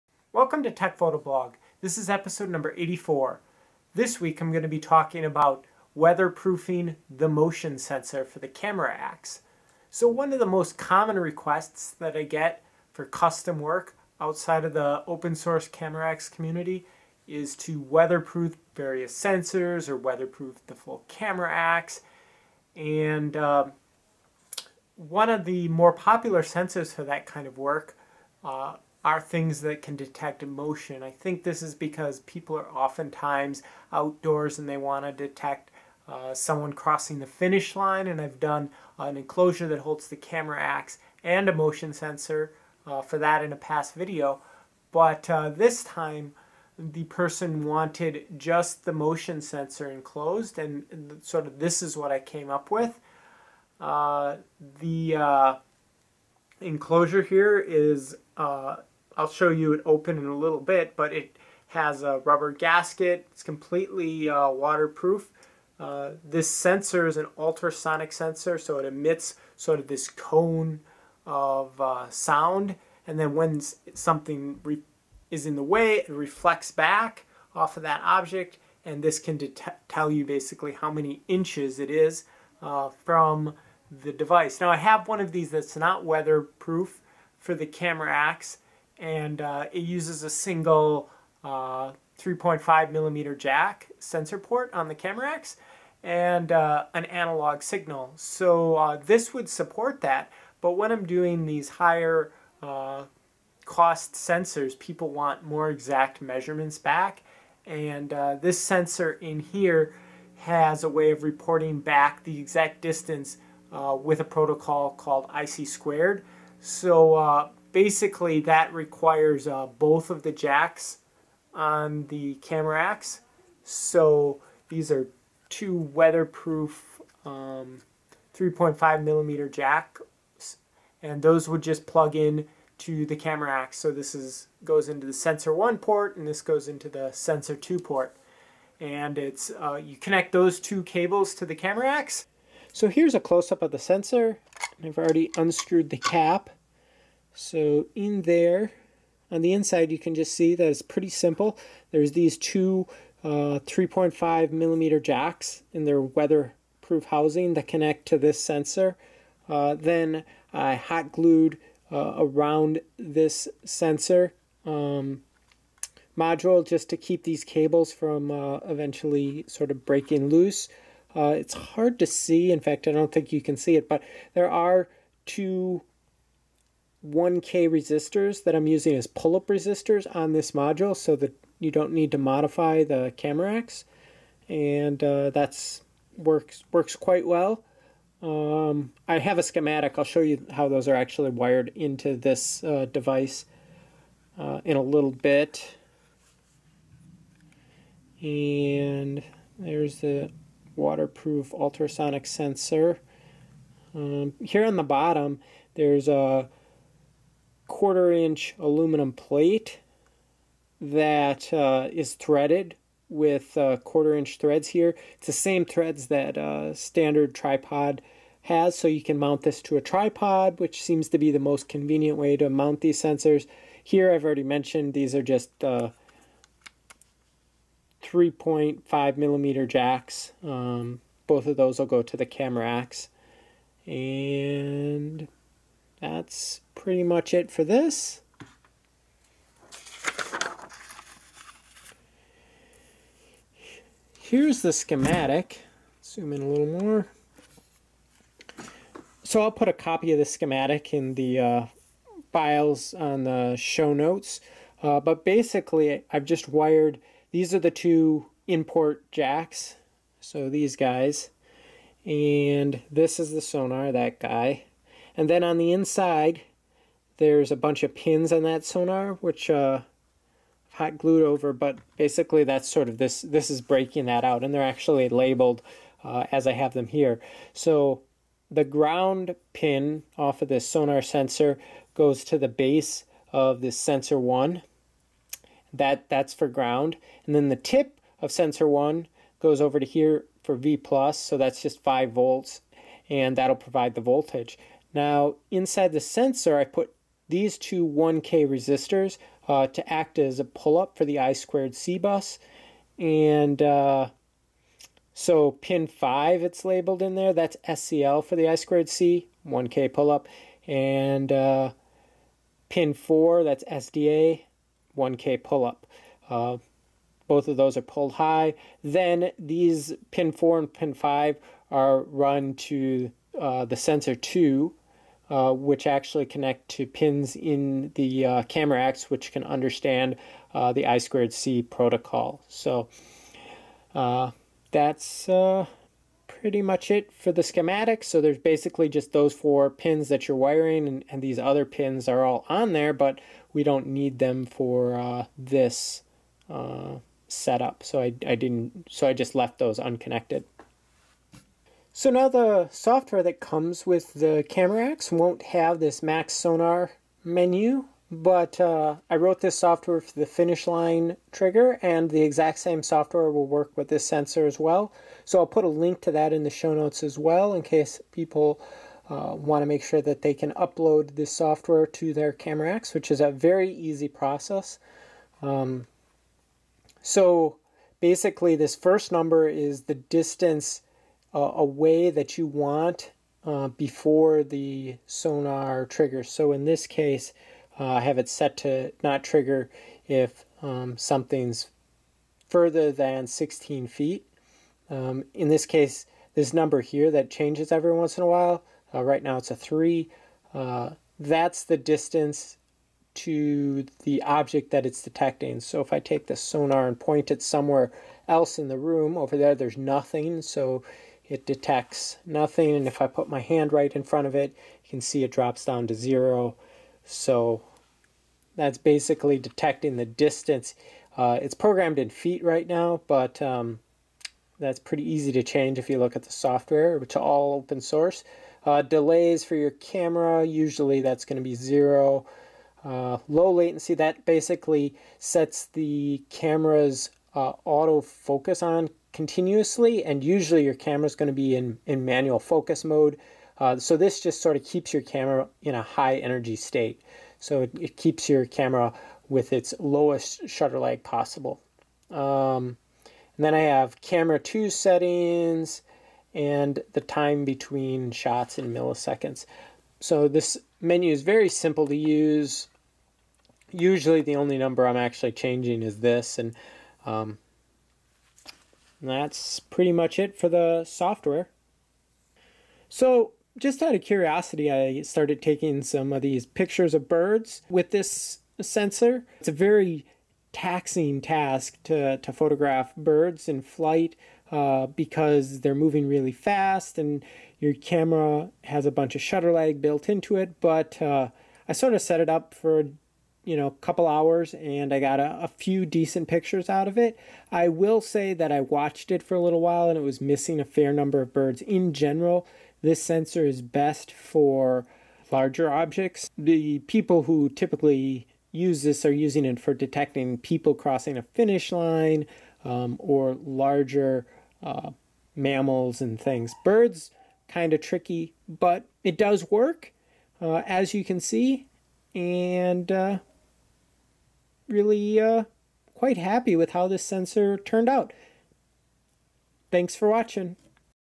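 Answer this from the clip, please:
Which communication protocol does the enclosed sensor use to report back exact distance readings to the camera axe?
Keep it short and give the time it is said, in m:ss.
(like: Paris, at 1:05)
I2C, at 1:55.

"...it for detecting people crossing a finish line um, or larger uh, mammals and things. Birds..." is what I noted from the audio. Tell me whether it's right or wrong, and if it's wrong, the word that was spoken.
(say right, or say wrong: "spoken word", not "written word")
right.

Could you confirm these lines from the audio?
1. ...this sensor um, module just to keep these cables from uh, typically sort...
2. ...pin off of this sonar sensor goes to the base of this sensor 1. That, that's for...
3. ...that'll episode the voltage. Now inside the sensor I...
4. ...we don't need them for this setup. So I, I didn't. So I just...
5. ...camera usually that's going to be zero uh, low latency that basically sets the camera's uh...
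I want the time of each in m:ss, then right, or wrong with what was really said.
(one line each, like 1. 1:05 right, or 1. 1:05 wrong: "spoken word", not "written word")
1. 2:42 wrong: "eventually", not "typically"
2. 4:39 right
3. 4:53 wrong: "provide", not "episode"
4. 5:43 right
5. 7:09 right.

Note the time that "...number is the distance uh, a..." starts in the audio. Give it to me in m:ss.
6:19.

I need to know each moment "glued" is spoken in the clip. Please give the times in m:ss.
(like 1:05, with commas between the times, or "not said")
2:41, 4:30.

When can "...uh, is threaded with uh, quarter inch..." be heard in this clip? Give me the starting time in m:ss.
3:31.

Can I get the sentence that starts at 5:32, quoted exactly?
So uh, that's uh, pretty much it for the schematic.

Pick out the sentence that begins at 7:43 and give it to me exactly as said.
Usually the only number I'm actually changing is this and um, that's pretty much it for the software.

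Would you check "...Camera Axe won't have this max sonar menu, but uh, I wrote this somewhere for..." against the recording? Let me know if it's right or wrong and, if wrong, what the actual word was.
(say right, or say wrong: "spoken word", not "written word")
wrong: "software", not "somewhere".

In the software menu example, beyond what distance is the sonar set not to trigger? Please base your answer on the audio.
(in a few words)
16 feet.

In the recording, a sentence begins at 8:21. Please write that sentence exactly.
In general, this sensor is best for larger objects.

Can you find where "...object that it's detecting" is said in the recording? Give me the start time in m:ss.
6:44.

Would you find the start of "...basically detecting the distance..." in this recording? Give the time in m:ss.
6:58.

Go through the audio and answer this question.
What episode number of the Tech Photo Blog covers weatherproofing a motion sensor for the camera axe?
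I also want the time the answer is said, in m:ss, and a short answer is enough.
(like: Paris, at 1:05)
84, at 0:02.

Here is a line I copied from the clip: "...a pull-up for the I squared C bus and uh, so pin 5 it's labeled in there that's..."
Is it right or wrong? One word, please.
right.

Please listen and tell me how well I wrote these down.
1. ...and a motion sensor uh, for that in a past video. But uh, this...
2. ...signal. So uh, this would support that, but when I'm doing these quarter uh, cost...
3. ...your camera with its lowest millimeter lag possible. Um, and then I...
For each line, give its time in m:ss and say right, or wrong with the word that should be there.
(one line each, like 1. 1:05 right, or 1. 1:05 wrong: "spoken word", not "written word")
1. 0:41 right
2. 1:37 wrong: "higher", not "quarter"
3. 7:28 wrong: "shutter", not "millimeter".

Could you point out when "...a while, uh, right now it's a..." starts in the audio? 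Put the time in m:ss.
6:38.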